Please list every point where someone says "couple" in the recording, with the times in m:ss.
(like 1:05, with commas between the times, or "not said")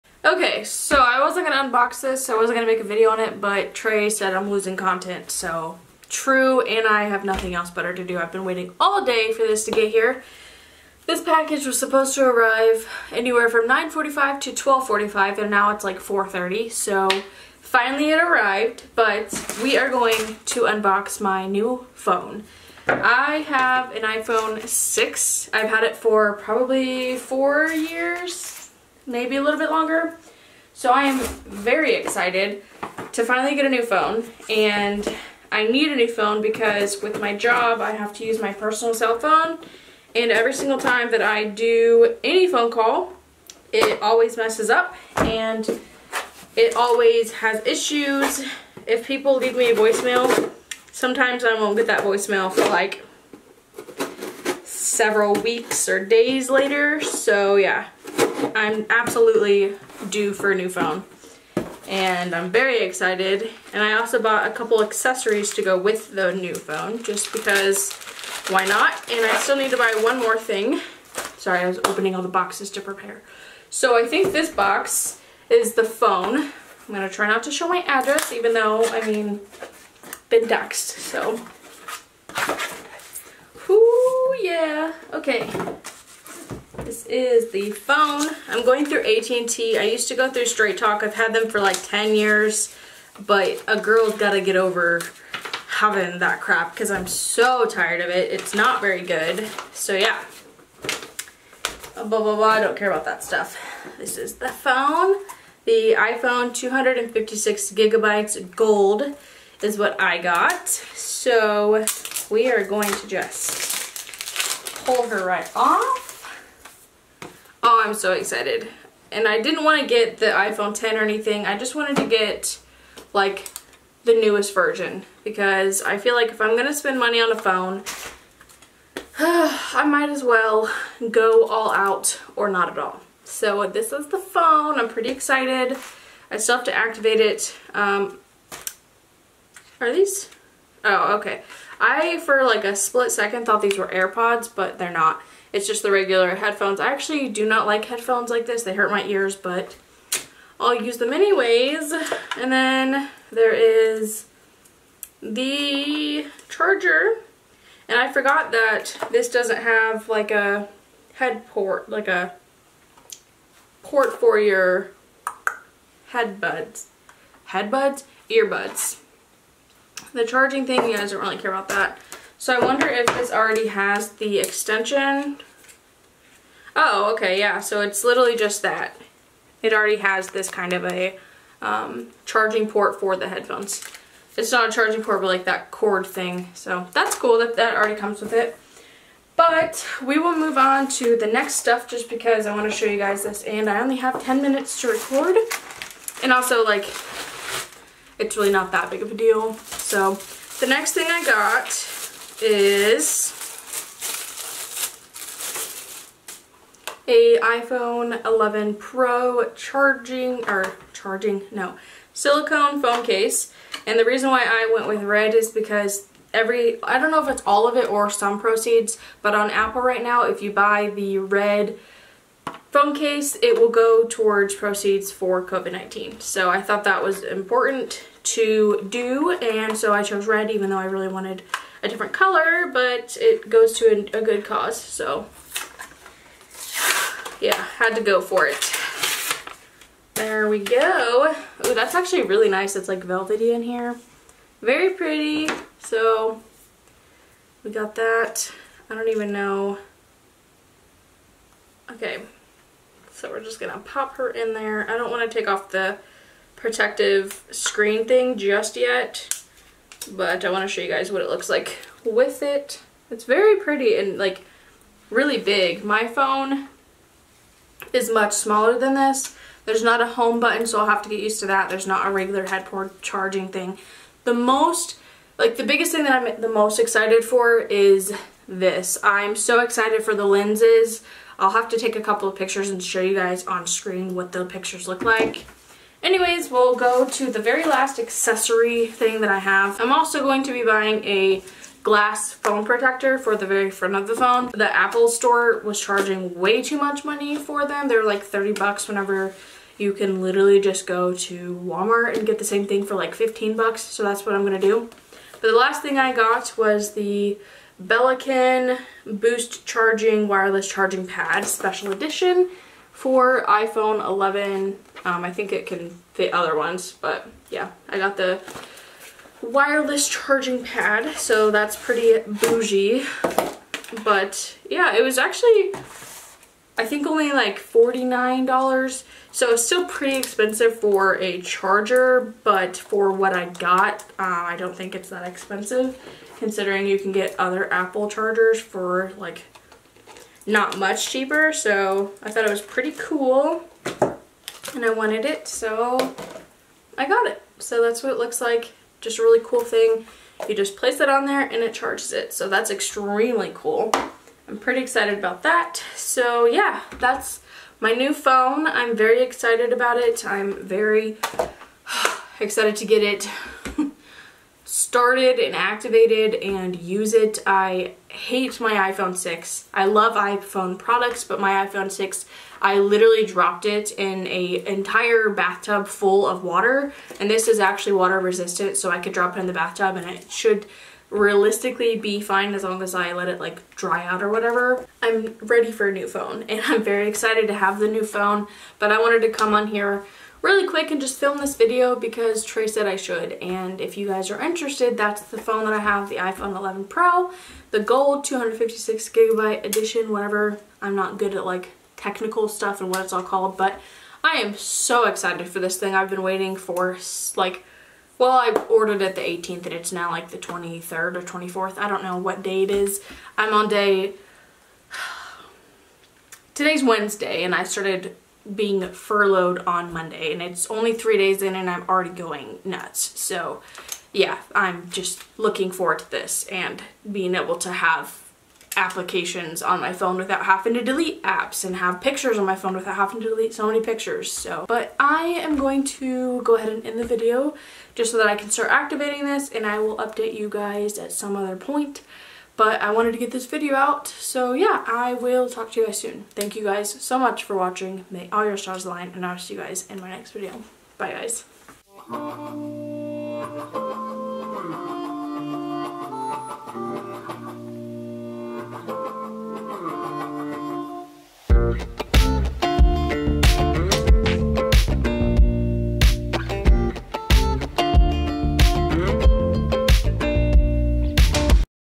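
1:04, 4:42.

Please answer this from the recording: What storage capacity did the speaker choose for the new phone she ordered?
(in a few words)
256 gigabytes.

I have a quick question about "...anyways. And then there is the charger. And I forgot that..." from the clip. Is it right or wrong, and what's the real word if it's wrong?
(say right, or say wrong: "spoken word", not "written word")
right.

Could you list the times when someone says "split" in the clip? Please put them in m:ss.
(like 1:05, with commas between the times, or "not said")
2:22.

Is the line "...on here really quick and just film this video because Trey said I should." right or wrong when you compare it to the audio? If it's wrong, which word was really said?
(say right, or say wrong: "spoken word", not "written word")
right.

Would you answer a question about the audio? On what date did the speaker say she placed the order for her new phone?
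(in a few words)
the 18th.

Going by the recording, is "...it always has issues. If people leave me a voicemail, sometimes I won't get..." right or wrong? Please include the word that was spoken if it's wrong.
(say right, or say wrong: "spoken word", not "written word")
right.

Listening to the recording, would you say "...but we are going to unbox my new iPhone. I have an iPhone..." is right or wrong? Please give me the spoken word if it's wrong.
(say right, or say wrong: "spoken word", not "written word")
wrong: "phone", not "iPhone".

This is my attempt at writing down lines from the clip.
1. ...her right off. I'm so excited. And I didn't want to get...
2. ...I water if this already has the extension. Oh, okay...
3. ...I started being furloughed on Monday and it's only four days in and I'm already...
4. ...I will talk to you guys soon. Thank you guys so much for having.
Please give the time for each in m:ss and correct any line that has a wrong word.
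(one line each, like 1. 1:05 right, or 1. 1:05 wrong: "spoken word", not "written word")
1. 1:55 right
2. 2:52 wrong: "wonder", not "water"
3. 6:57 wrong: "three", not "four"
4. 7:24 wrong: "watching", not "having".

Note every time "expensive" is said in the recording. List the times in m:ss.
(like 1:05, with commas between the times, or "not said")
5:30, 5:35.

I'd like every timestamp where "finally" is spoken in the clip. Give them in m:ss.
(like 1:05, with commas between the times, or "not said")
0:17, 0:33.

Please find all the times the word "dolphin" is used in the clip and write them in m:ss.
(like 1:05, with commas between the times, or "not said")
not said.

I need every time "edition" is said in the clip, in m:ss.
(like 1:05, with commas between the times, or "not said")
5:11, 6:39.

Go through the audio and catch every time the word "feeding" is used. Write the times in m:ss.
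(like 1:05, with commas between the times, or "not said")
not said.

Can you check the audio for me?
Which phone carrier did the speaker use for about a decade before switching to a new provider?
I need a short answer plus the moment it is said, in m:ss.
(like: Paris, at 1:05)
Straight Talk, at 1:30.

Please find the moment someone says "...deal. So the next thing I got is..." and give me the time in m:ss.
3:19.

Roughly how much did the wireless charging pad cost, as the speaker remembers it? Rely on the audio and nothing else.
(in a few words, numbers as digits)
$49.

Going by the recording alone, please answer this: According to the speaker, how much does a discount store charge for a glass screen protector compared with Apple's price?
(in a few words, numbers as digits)
$15.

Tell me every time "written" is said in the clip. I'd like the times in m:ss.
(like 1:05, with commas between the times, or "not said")
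not said.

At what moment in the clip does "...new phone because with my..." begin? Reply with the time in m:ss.
0:35.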